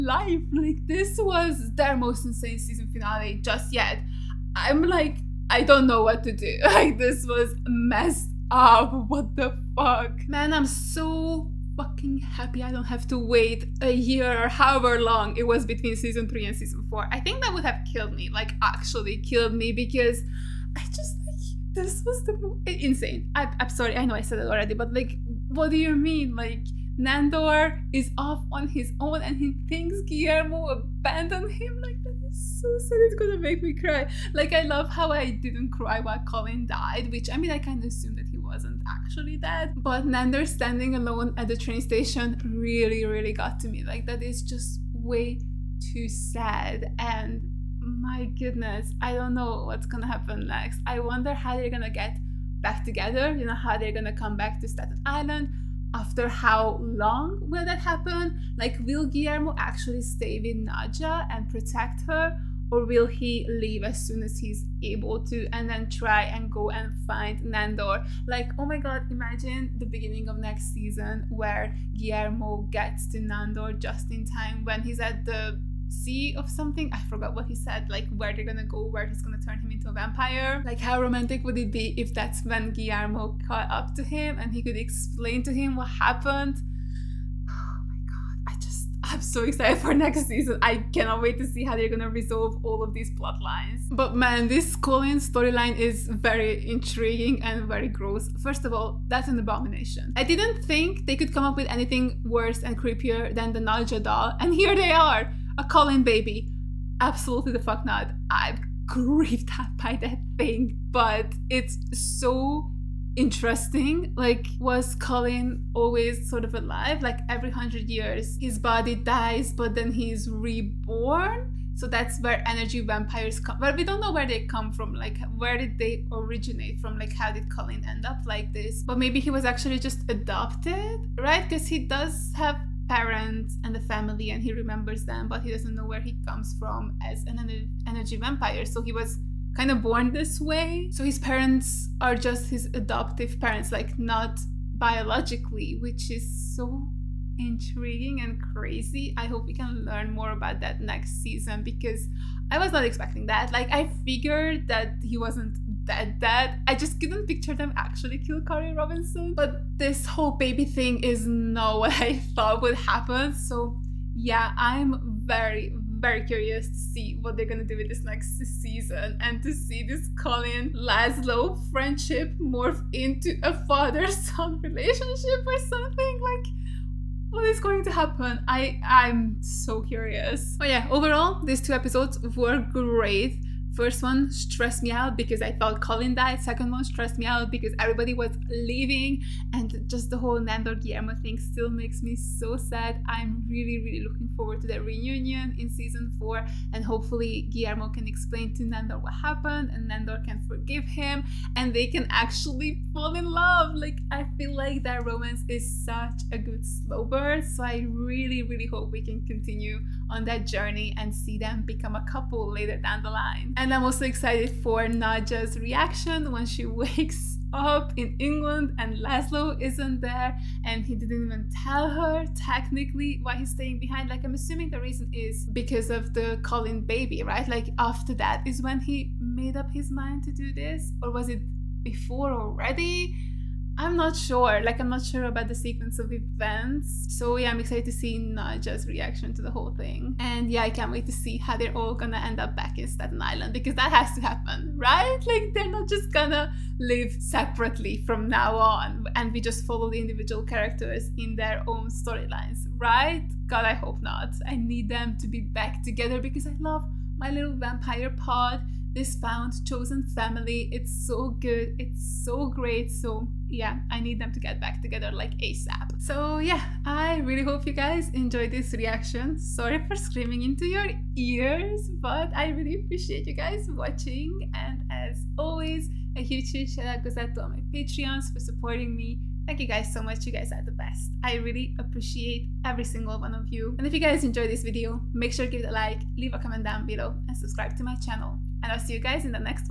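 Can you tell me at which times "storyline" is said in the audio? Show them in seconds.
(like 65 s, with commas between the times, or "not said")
95 s, 251 s.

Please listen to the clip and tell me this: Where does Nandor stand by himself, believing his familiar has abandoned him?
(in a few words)
Train station.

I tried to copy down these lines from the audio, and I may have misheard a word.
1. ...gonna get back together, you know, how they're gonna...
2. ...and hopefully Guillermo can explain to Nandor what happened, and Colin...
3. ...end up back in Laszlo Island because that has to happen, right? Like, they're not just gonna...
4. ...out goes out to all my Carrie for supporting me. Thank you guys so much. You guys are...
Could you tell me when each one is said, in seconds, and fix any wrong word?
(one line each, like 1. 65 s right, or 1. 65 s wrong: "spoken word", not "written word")
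1. 51 s right
2. 196 s wrong: "Nandor", not "Colin"
3. 242 s wrong: "Staten", not "Laszlo"
4. 276 s wrong: "Patreons", not "Carrie".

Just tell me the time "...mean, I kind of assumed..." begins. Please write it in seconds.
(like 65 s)
37 s.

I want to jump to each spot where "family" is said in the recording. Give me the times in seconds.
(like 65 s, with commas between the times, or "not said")
133 s, 260 s.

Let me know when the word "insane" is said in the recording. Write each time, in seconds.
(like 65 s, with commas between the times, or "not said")
2 s, 22 s.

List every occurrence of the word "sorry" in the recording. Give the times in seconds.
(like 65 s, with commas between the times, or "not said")
23 s, 269 s.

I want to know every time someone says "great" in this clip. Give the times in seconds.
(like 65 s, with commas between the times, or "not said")
182 s, 262 s.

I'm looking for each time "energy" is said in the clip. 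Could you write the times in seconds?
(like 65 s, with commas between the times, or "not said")
122 s, 137 s.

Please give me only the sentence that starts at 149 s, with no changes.
I hope we can learn more about that next season because I was not expecting that.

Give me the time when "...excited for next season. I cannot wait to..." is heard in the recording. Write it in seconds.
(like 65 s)
89 s.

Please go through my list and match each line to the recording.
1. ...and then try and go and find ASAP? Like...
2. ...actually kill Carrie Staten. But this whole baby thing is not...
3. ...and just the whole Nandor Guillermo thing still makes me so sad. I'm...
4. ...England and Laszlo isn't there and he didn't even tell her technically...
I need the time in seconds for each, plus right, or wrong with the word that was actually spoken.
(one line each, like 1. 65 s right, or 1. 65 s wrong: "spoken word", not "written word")
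1. 65 s wrong: "Nandor", not "ASAP"
2. 157 s wrong: "Robinson", not "Staten"
3. 189 s right
4. 218 s right.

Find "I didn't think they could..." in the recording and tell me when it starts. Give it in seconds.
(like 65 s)
100 s.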